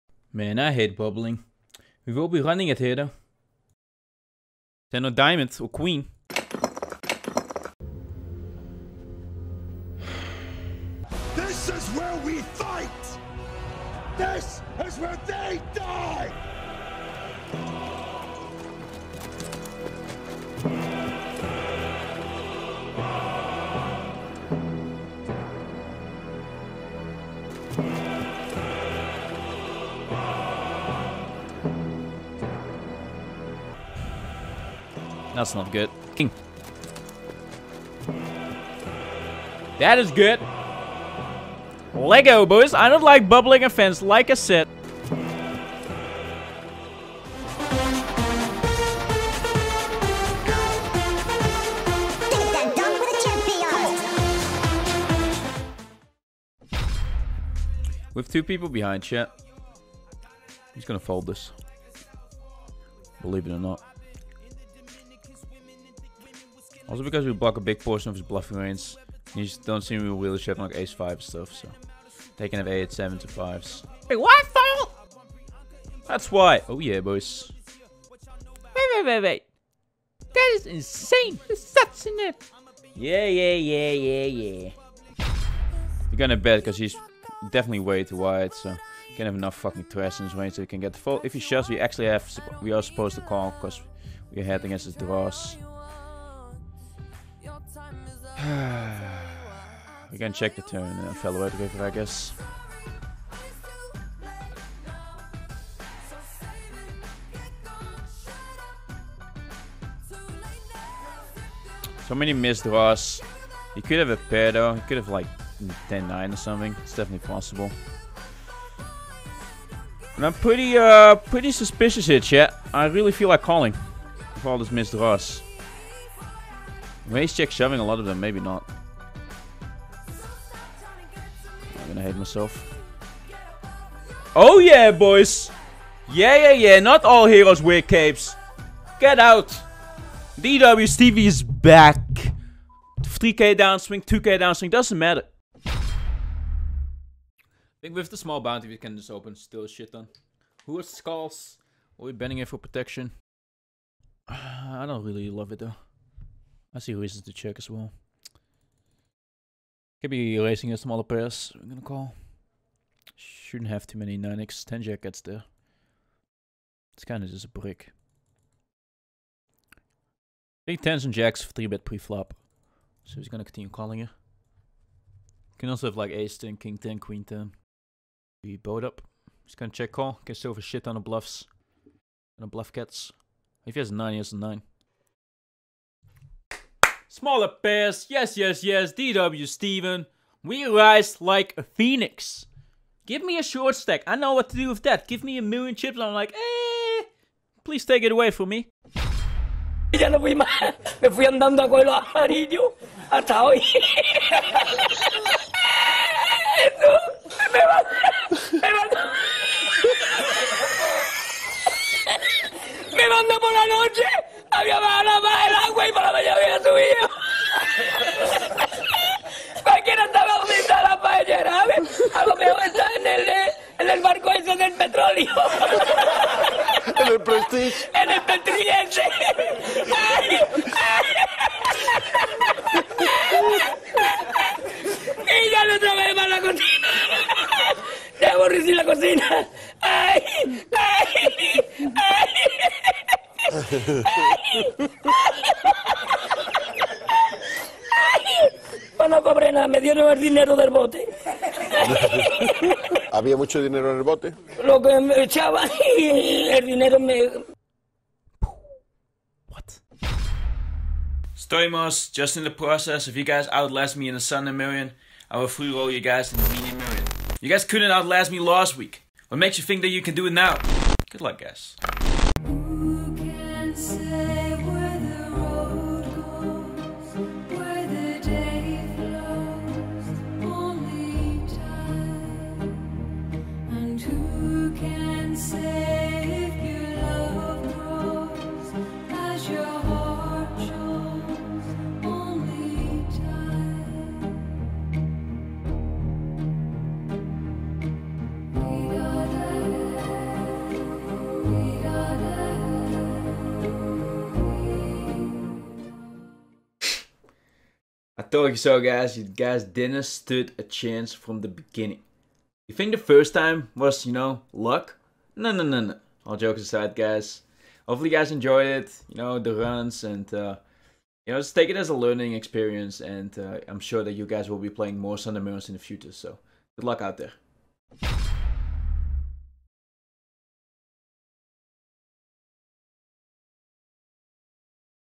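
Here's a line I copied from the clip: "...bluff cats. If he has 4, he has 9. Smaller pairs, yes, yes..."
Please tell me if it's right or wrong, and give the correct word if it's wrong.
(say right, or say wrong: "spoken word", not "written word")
wrong: "9", not "4".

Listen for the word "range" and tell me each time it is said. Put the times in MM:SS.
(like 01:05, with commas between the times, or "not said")
01:08, 01:30.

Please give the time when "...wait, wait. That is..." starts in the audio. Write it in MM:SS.
01:19.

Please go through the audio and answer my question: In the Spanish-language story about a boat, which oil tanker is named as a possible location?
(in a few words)
Prestige.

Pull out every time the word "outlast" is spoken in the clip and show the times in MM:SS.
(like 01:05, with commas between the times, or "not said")
04:23, 04:27.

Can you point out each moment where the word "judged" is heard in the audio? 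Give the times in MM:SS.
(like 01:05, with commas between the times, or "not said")
not said.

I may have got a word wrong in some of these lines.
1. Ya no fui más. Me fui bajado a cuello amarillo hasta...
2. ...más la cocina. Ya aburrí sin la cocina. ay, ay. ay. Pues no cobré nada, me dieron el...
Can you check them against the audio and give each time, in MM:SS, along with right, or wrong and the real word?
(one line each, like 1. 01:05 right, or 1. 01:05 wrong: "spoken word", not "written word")
1. 03:19 wrong: "andando", not "bajado"
2. 03:56 right.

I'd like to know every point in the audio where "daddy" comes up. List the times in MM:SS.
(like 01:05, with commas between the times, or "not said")
not said.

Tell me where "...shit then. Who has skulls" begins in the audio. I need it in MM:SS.
02:29.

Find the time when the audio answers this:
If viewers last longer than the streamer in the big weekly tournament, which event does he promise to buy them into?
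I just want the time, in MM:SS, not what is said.
04:26.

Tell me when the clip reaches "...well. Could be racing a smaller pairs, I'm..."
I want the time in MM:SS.
02:37.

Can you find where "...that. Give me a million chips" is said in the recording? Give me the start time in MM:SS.
03:14.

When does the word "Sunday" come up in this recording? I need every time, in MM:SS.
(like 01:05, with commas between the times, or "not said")
04:24, 05:25.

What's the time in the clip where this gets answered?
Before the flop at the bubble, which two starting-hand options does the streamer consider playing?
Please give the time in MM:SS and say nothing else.
00:04.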